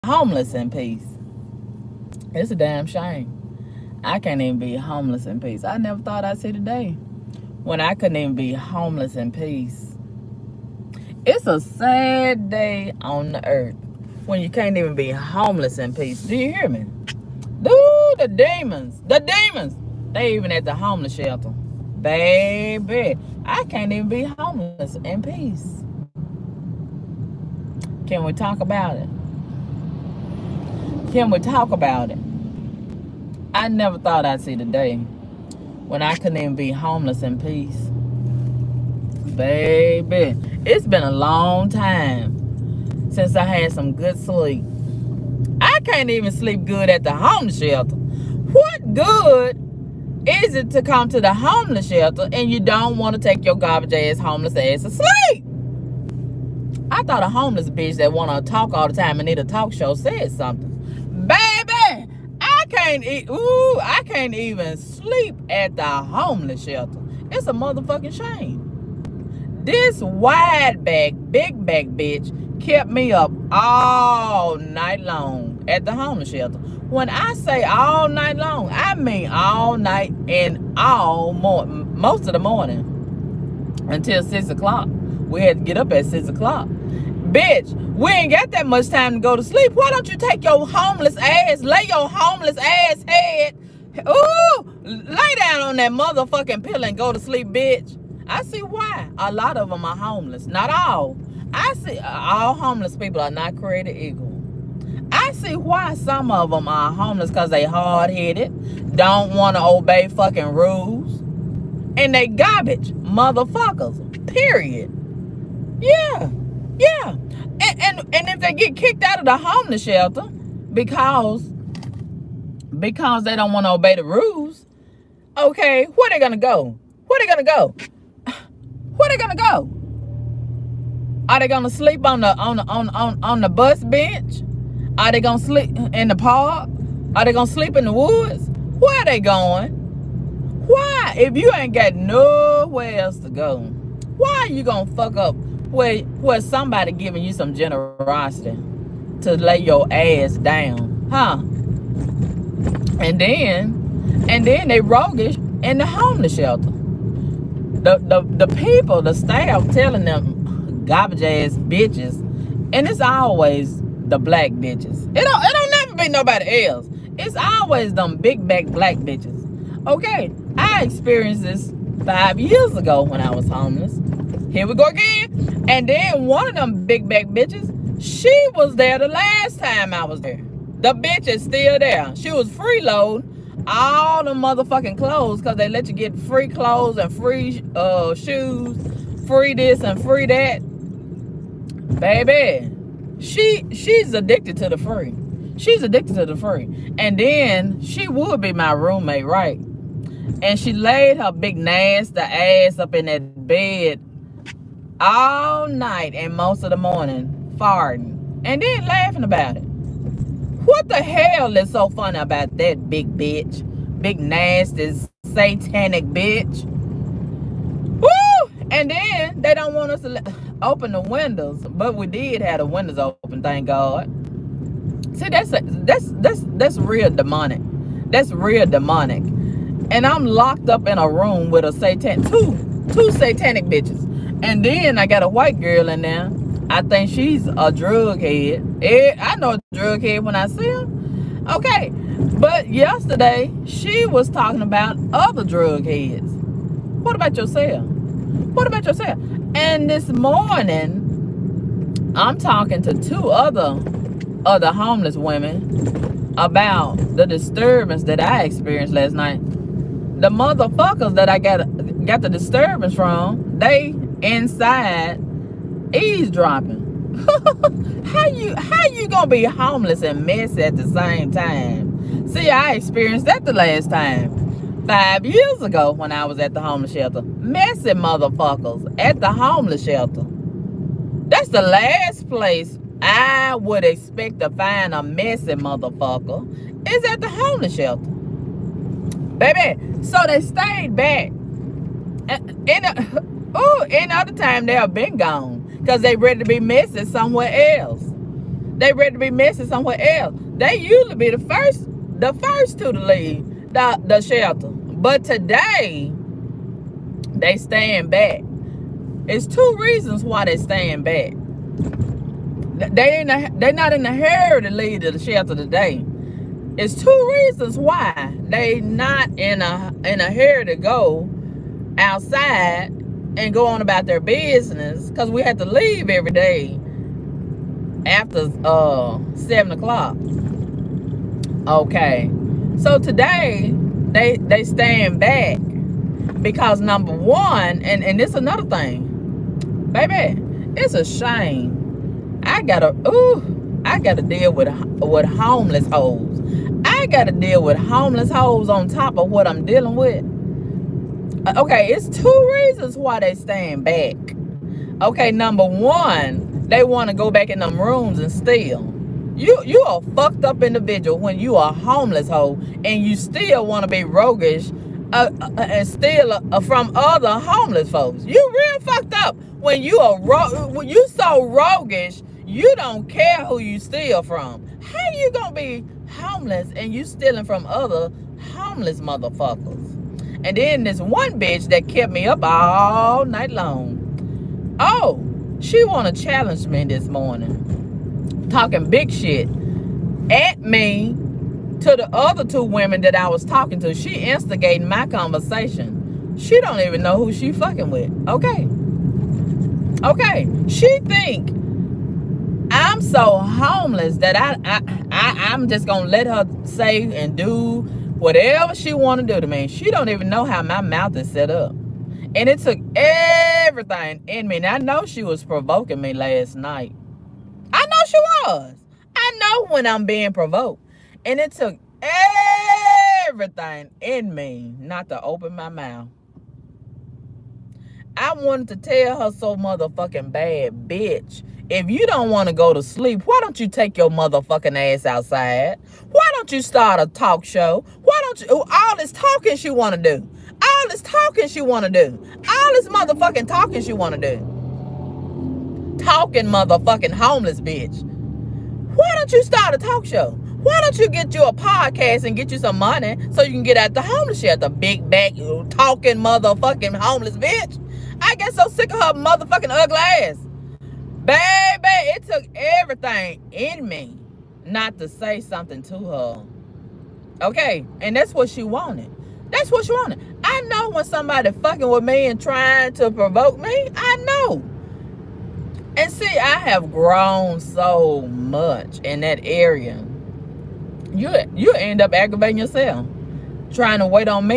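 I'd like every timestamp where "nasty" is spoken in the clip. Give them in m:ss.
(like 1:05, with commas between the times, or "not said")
3:21, 3:34.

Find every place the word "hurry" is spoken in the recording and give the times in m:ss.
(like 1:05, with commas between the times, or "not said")
5:14, 5:20.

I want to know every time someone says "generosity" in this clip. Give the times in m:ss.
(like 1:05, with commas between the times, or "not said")
2:27.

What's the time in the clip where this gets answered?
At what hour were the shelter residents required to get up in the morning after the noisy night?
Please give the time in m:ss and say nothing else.
1:25.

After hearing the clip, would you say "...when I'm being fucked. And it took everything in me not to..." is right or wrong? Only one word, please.
wrong.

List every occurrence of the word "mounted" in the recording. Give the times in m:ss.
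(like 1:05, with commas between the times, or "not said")
not said.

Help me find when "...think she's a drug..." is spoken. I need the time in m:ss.
3:56.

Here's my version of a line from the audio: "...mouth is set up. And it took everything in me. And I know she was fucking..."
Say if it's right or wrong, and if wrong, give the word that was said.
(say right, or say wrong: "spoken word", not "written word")
wrong: "provoking", not "fucking".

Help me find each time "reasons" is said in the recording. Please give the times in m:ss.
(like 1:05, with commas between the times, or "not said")
5:09, 5:17, 5:52.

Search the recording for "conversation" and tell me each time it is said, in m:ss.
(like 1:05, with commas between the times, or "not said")
6:35.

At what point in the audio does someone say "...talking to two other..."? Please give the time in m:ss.
4:12.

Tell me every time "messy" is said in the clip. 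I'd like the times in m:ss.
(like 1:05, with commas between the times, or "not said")
4:30, 4:37, 4:45.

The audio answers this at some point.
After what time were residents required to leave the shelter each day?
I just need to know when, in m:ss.
5:29.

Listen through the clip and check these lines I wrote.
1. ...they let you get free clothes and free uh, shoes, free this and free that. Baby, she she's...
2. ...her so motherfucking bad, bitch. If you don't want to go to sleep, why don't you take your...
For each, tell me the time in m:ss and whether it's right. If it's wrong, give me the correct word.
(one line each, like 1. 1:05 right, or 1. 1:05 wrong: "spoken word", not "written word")
1. 3:05 right
2. 7:09 right.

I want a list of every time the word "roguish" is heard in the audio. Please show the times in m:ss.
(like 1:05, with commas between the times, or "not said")
2:34, 6:04, 6:11.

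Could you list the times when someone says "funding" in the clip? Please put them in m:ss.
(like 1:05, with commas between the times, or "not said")
not said.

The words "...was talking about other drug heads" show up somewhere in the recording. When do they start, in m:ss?
4:04.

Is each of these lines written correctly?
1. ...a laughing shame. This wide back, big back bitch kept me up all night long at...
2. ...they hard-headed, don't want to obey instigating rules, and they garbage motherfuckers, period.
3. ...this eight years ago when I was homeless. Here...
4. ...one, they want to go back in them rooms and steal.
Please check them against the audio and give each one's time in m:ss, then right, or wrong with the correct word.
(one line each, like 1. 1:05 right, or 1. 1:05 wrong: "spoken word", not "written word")
1. 1:07 wrong: "motherfucking", not "laughing"
2. 1:47 wrong: "fucking", not "instigating"
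3. 2:51 wrong: "five", not "eight"
4. 5:55 right.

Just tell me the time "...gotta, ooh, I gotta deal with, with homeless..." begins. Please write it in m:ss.
5:42.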